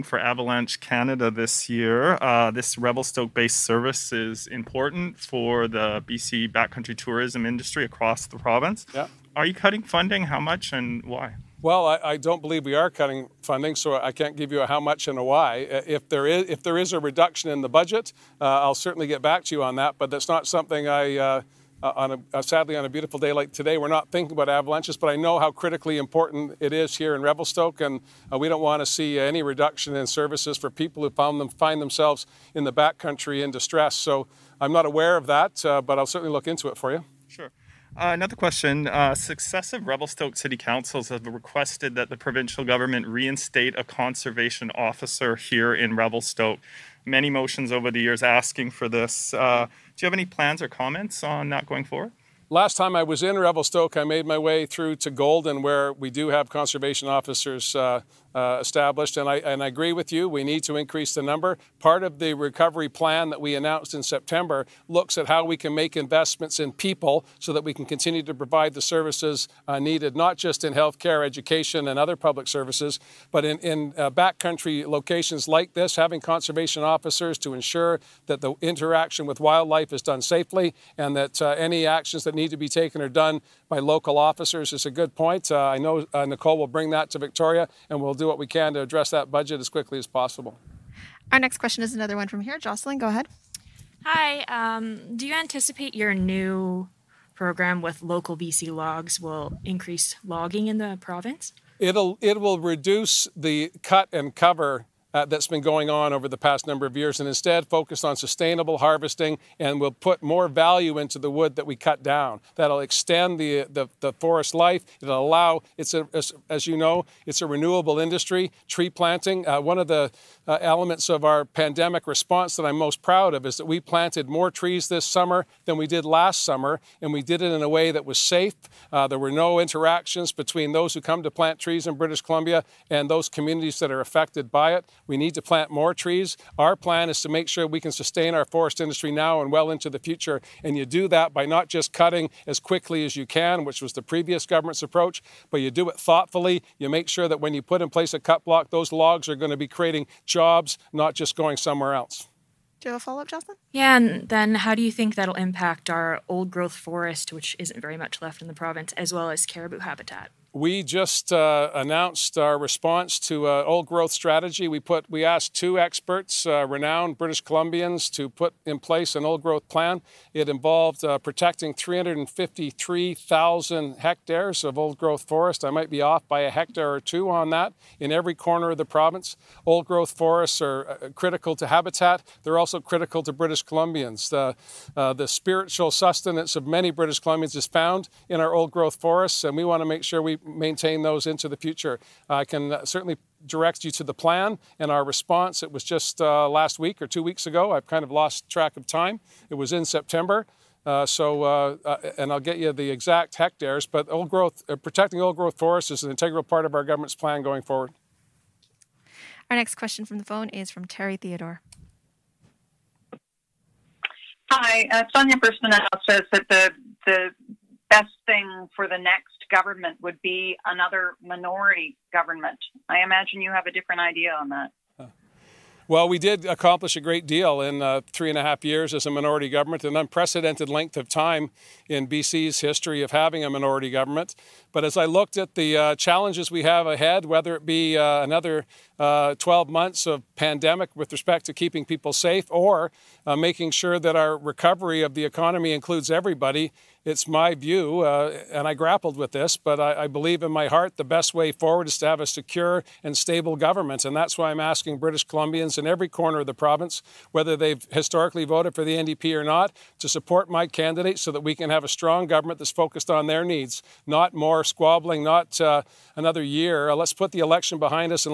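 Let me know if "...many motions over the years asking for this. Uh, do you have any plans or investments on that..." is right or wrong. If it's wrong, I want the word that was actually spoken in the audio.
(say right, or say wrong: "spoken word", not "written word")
wrong: "comments", not "investments".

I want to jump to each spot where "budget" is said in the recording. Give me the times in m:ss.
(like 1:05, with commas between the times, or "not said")
0:17, 1:29.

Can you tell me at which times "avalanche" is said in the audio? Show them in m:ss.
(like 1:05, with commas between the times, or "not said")
0:00, 0:24.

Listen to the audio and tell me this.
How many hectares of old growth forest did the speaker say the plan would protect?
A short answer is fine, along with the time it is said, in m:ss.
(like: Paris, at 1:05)
353,000, at 2:51.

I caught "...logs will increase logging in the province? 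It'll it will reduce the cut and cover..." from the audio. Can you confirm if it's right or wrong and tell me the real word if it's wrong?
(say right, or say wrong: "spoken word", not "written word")
right.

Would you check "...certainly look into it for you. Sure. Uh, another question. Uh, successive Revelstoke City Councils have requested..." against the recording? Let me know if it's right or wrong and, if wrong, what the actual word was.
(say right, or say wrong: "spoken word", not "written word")
right.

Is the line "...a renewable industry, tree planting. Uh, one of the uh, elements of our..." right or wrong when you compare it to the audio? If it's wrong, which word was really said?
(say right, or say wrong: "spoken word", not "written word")
right.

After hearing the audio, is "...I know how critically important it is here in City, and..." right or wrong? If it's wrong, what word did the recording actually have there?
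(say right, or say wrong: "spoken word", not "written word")
wrong: "Revelstoke", not "City".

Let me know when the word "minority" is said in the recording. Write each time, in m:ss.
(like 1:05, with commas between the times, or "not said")
3:41, 3:49, 3:53.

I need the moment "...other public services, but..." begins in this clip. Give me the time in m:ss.
1:11.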